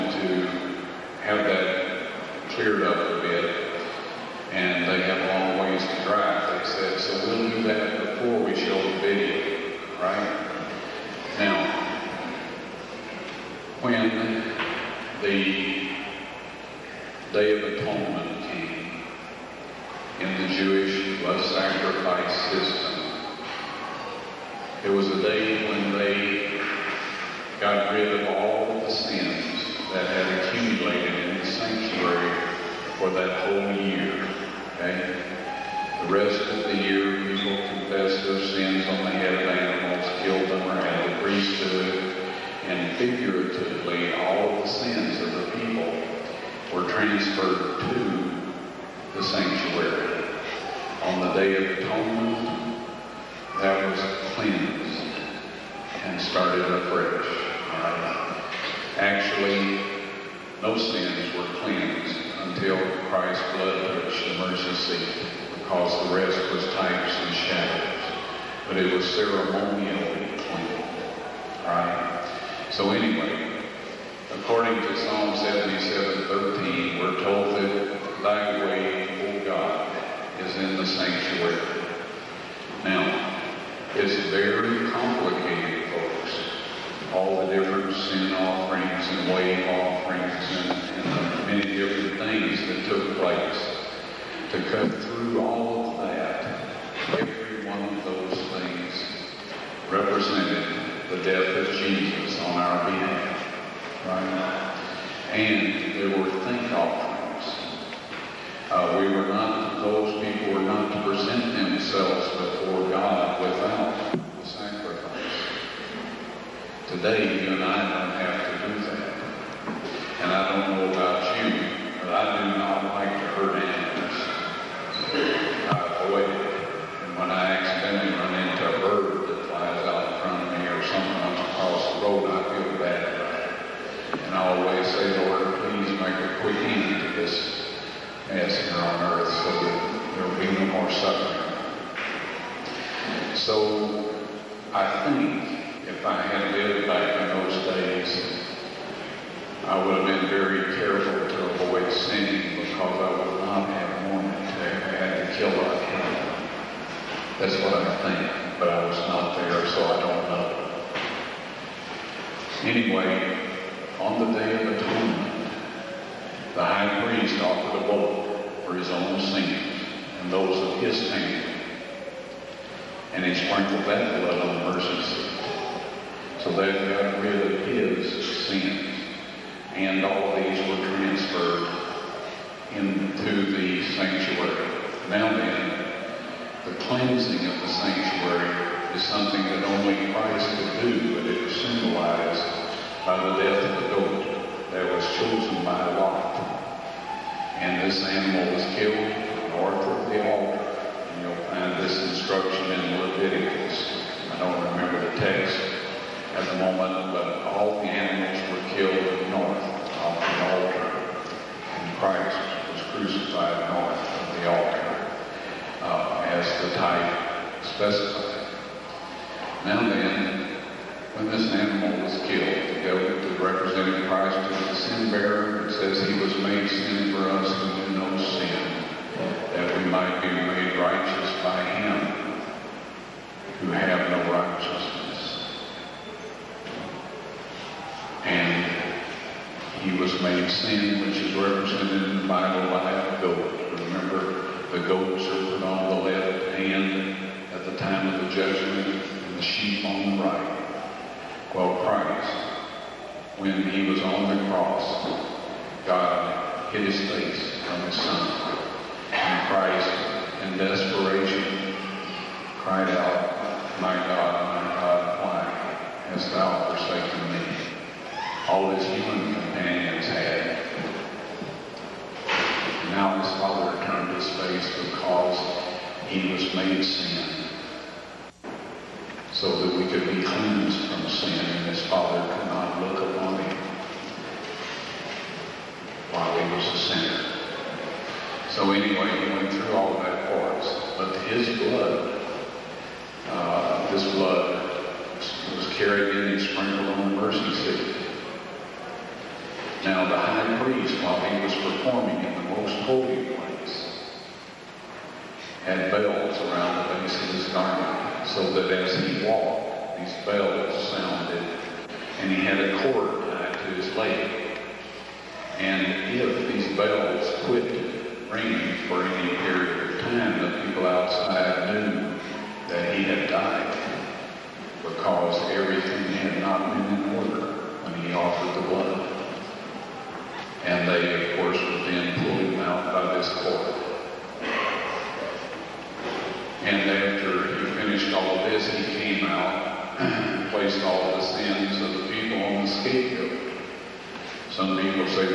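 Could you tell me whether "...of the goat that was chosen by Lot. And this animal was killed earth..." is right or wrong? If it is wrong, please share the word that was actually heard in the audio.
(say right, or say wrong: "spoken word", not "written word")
wrong: "north", not "earth".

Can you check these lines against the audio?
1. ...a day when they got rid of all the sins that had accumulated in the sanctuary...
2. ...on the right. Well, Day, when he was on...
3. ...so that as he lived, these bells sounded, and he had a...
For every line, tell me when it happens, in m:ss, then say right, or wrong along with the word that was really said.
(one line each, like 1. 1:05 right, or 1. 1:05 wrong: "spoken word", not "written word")
1. 0:25 right
2. 4:09 wrong: "Christ", not "Day"
3. 5:08 wrong: "walked", not "lived".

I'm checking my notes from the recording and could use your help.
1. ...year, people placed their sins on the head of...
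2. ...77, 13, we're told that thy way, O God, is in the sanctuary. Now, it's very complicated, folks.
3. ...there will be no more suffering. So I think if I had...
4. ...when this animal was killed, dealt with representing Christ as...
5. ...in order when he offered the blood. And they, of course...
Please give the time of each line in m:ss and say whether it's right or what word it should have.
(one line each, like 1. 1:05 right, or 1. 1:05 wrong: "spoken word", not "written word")
1. 0:36 wrong: "confessed", not "placed"
2. 1:15 right
3. 2:20 right
4. 3:41 right
5. 5:27 right.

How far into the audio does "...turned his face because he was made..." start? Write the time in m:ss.
4:33.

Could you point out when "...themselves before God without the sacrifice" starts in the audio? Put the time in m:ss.
1:51.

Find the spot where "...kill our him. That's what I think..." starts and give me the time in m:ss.
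2:35.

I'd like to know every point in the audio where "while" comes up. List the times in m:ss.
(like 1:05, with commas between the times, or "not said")
4:46, 5:01.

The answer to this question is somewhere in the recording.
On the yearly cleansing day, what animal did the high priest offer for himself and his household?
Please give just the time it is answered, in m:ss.
2:47.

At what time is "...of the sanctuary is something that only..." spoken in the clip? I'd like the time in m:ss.
3:07.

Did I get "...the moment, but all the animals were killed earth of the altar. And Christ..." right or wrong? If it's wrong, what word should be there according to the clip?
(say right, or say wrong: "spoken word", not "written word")
wrong: "north", not "earth".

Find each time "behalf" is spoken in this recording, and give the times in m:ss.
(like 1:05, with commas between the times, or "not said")
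1:42.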